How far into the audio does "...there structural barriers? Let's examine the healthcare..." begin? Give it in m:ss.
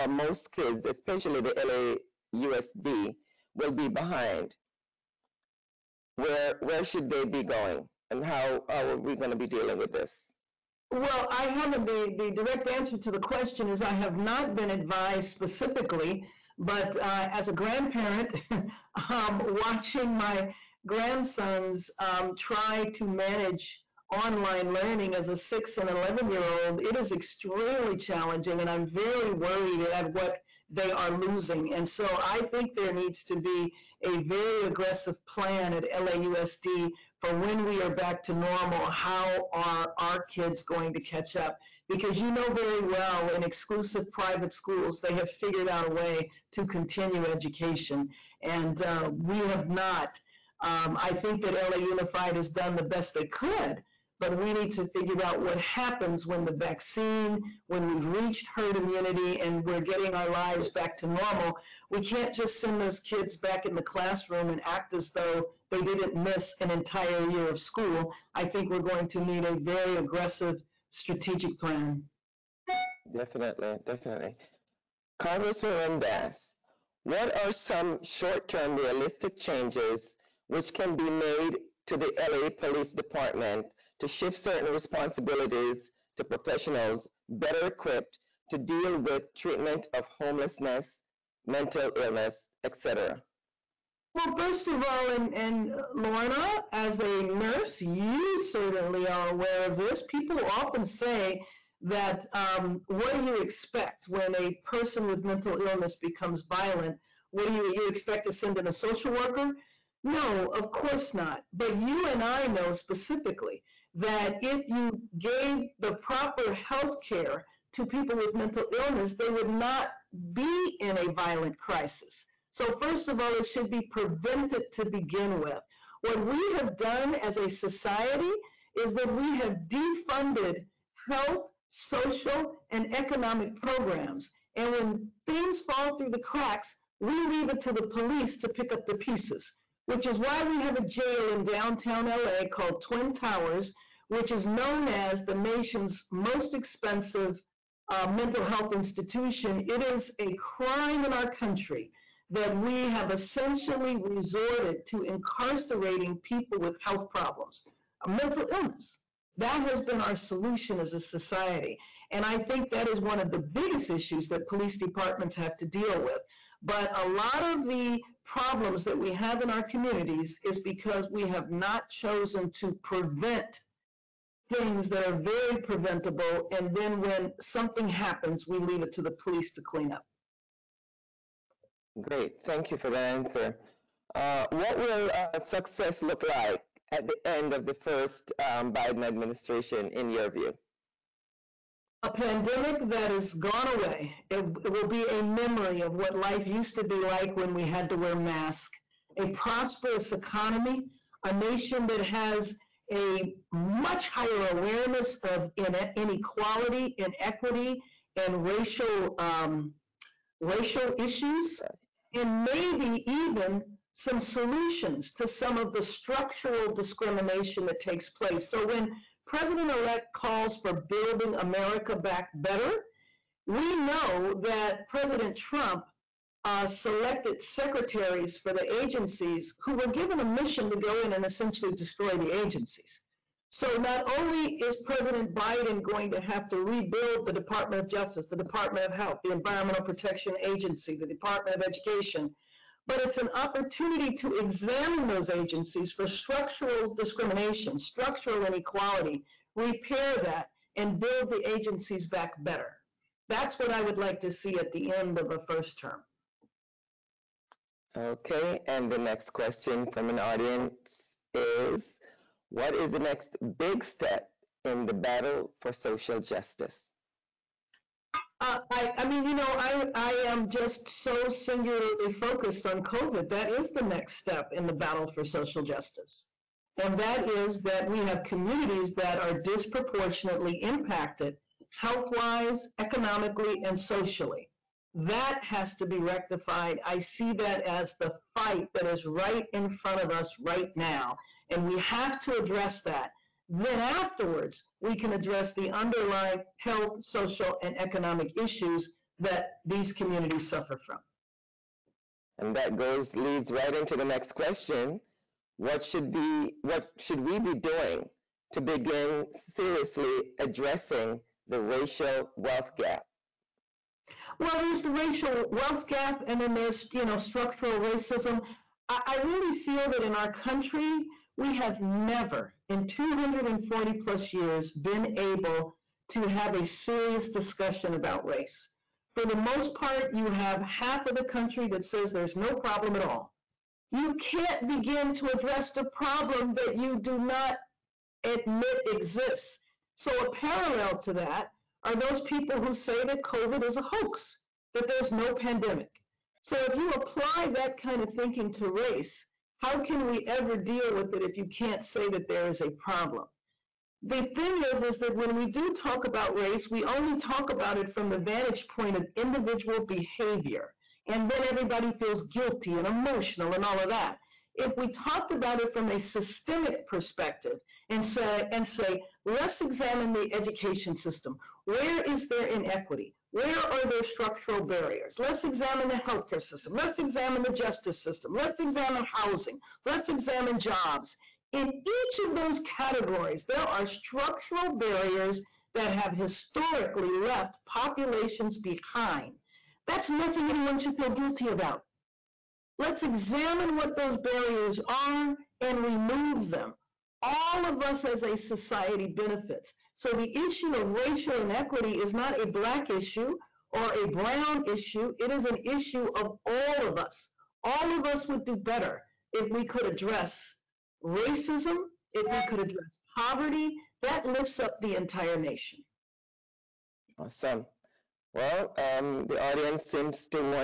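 6:13.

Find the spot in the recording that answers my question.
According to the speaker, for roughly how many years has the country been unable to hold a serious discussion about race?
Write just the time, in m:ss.
5:22.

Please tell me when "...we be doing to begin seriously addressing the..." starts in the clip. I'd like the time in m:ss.
5:07.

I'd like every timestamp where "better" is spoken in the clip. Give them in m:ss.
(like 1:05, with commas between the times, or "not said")
1:27, 3:42, 4:12, 6:48.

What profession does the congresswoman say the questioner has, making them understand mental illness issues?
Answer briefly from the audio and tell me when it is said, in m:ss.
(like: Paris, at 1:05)
Nurse, at 1:37.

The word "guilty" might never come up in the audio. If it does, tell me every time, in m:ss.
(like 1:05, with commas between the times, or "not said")
6:02, 6:31.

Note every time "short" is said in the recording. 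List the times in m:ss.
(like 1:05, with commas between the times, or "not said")
1:18.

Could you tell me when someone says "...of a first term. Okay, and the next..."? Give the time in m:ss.
4:15.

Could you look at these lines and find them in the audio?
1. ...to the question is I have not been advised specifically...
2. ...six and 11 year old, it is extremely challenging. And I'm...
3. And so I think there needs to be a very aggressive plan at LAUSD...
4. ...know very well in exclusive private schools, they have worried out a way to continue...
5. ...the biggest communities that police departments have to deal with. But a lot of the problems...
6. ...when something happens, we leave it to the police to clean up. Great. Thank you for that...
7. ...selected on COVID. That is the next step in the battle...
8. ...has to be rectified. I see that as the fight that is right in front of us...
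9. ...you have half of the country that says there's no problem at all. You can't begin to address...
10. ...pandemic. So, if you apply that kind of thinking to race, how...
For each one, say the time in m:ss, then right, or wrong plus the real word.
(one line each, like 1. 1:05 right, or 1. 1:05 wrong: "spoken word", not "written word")
1. 0:12 right
2. 0:25 right
3. 0:31 right
4. 0:42 wrong: "figured", not "worried"
5. 2:43 wrong: "issues", not "communities"
6. 2:57 right
7. 4:32 wrong: "focused", not "selected"
8. 4:45 right
9. 5:30 right
10. 5:45 right.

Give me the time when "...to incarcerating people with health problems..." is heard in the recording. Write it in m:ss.
2:34.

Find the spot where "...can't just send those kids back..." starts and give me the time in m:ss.
1:02.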